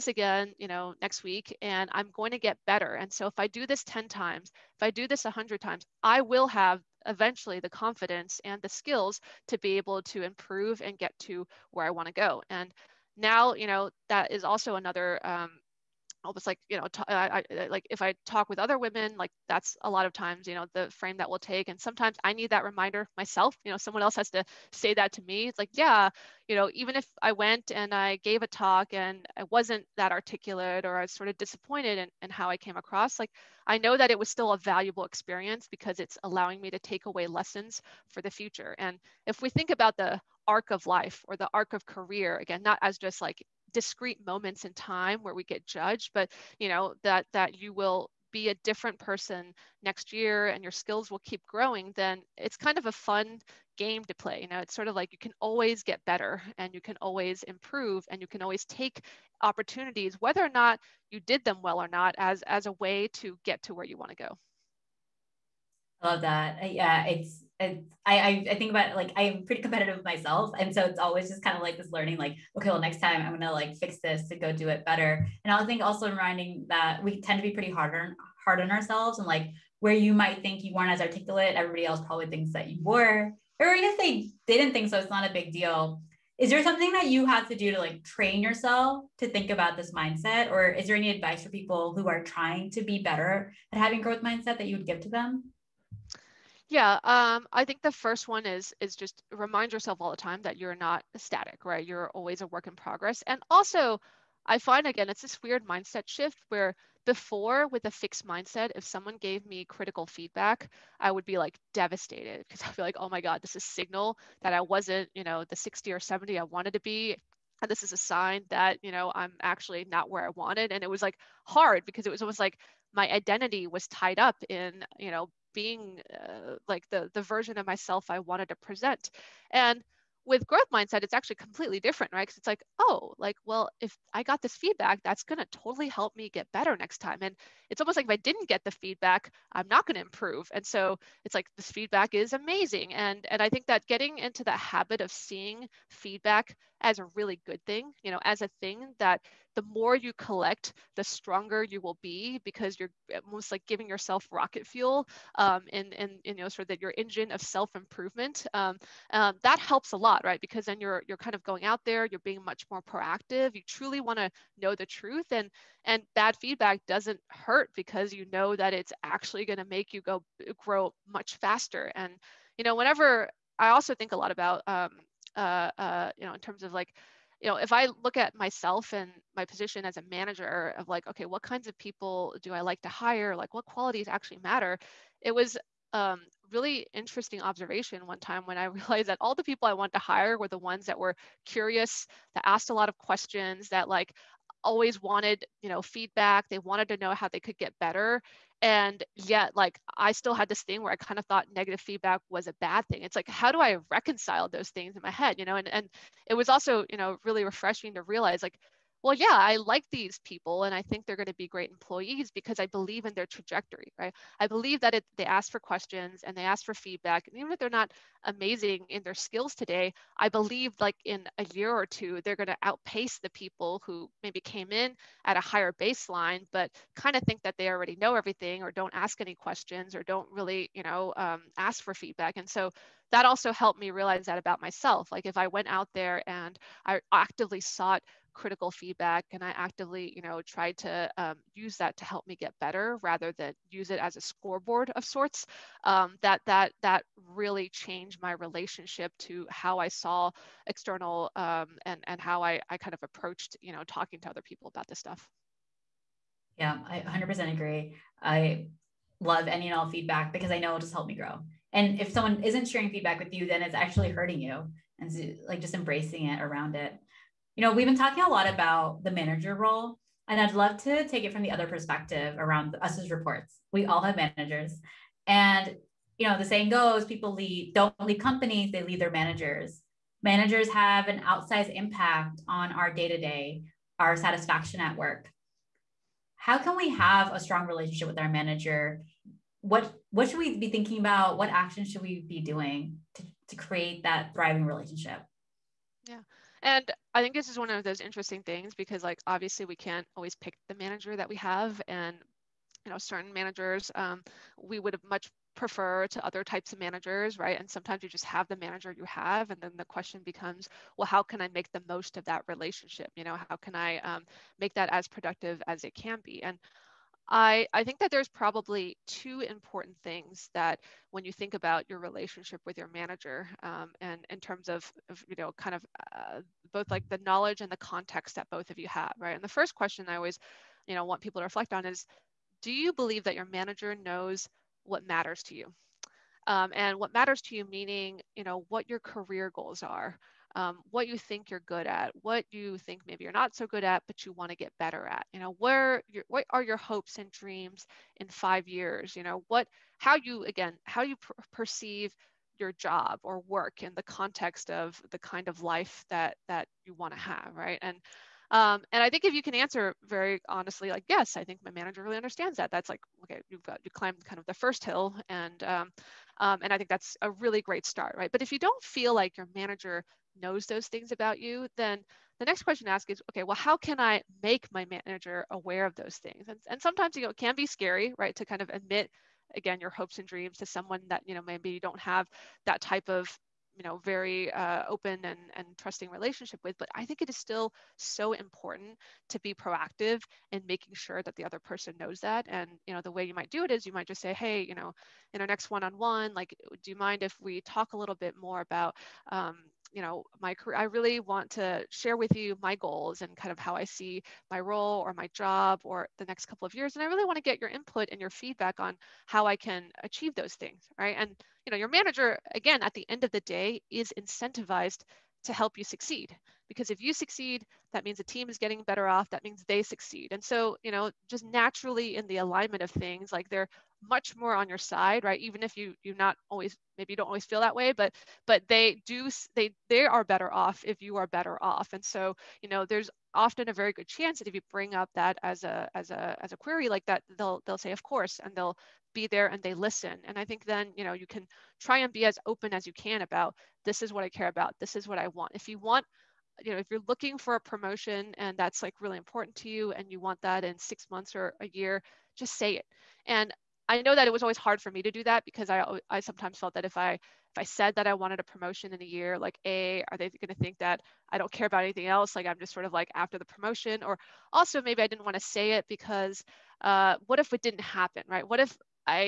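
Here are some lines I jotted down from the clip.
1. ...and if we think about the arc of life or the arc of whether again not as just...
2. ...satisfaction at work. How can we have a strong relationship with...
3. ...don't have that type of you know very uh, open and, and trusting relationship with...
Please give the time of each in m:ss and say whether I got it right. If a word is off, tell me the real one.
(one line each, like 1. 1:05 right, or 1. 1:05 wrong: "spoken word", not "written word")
1. 0:38 wrong: "career", not "whether"
2. 4:44 right
3. 6:21 right.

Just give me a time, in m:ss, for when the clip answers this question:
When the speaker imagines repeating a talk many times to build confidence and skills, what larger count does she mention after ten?
0:05.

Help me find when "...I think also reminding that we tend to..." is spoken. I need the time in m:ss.
1:15.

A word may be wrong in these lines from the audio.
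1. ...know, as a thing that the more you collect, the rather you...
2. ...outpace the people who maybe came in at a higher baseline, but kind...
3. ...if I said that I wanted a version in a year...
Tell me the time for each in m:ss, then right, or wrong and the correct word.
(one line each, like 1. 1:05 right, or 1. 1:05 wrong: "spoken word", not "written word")
1. 2:28 wrong: "stronger", not "rather"
2. 3:42 right
3. 7:37 wrong: "promotion", not "version".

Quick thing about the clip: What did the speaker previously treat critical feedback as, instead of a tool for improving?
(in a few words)
scoreboard.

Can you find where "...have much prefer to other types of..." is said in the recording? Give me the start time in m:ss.
5:04.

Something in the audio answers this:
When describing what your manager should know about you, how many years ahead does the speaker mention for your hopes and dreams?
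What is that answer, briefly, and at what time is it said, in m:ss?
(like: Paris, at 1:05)
5, at 5:48.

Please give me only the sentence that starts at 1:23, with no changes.
Or even if they didn't think so, it's not a big deal.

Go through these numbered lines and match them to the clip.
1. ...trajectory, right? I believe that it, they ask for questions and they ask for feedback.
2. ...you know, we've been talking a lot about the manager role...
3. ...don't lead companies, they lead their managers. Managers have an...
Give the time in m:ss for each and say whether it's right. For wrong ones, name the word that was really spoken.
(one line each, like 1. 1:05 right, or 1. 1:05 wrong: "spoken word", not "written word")
1. 3:33 right
2. 4:27 right
3. 4:37 right.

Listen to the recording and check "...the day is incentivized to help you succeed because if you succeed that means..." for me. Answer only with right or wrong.
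right.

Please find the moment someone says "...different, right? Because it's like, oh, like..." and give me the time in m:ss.
2:11.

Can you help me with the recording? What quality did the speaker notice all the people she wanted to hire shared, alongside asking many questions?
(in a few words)
curious.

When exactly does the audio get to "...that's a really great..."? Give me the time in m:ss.
6:06.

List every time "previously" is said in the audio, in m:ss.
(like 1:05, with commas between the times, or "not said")
not said.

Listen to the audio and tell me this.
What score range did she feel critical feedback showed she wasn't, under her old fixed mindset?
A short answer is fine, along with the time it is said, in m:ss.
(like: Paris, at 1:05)
60 or 70, at 1:55.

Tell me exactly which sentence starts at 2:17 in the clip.
And it's almost like if I didn't get the feedback, I'm not going to improve.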